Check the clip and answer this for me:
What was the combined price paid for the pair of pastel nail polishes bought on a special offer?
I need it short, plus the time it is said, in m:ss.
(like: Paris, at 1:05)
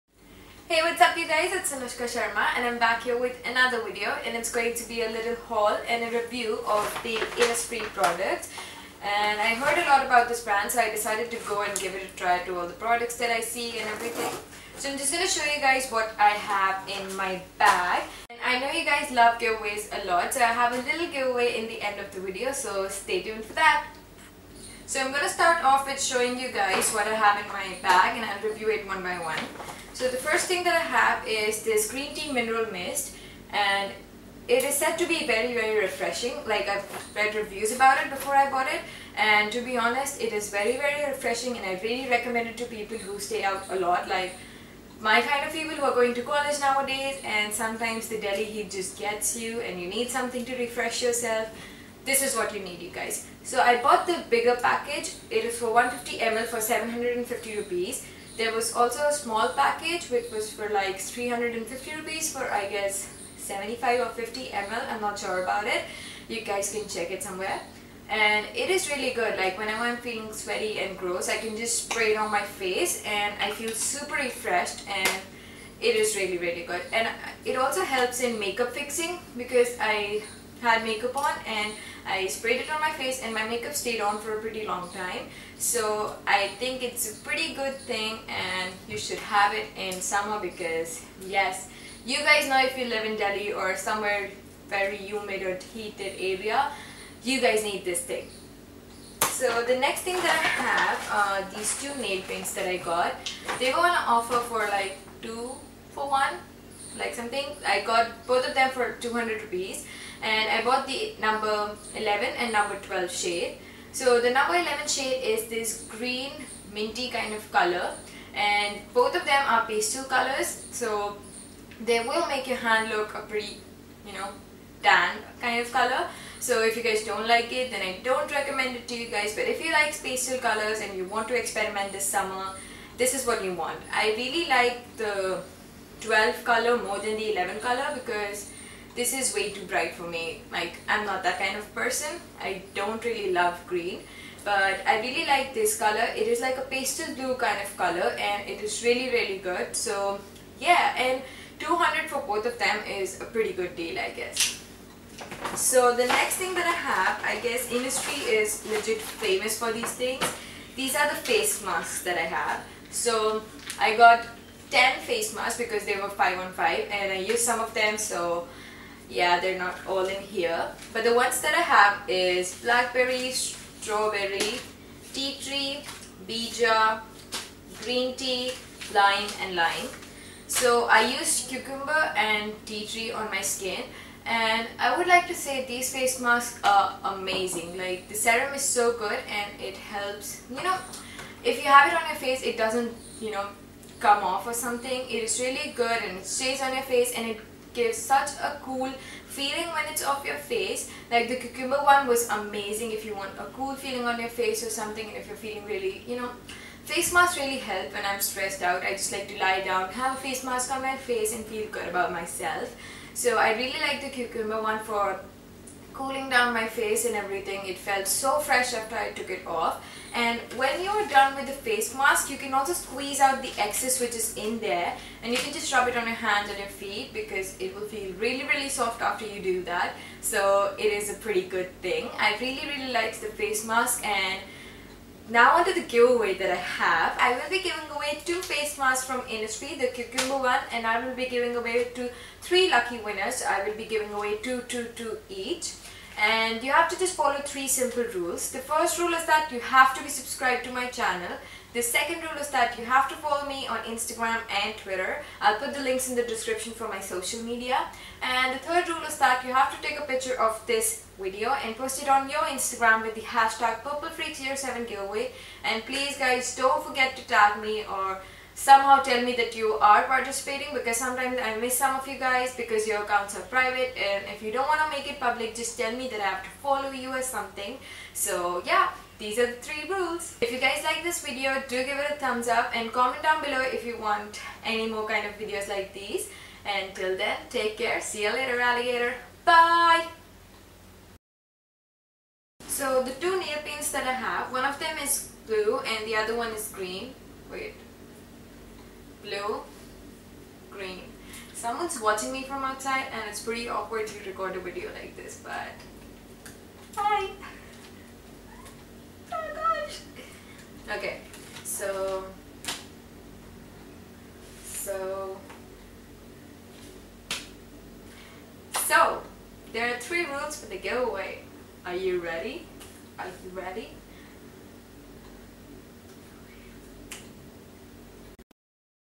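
200 rupees, at 1:48.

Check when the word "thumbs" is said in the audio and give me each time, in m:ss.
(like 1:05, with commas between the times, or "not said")
4:42.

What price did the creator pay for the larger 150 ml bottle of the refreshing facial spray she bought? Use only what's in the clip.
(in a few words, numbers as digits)
750 rupees.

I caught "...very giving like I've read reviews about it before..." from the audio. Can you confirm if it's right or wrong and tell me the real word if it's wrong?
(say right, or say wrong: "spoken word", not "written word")
wrong: "refreshing", not "giving".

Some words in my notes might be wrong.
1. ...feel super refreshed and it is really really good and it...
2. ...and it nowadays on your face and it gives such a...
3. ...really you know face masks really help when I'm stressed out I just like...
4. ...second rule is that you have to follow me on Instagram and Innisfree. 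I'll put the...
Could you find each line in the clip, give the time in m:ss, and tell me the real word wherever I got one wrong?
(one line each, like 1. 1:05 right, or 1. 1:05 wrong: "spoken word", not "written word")
1. 1:13 right
2. 3:16 wrong: "stays", not "nowadays"
3. 3:25 right
4. 4:11 wrong: "Twitter", not "Innisfree".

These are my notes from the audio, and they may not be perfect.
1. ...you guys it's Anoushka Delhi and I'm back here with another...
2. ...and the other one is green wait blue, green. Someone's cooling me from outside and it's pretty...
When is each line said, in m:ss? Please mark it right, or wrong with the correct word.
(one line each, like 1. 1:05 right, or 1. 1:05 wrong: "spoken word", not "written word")
1. 0:01 wrong: "Sharma", not "Delhi"
2. 4:55 wrong: "watching", not "cooling".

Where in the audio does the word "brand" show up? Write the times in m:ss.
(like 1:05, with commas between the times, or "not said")
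0:10.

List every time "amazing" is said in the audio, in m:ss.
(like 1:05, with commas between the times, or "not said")
3:07, 3:22.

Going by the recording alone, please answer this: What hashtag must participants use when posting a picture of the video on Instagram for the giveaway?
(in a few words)
purplefreak07giveaway.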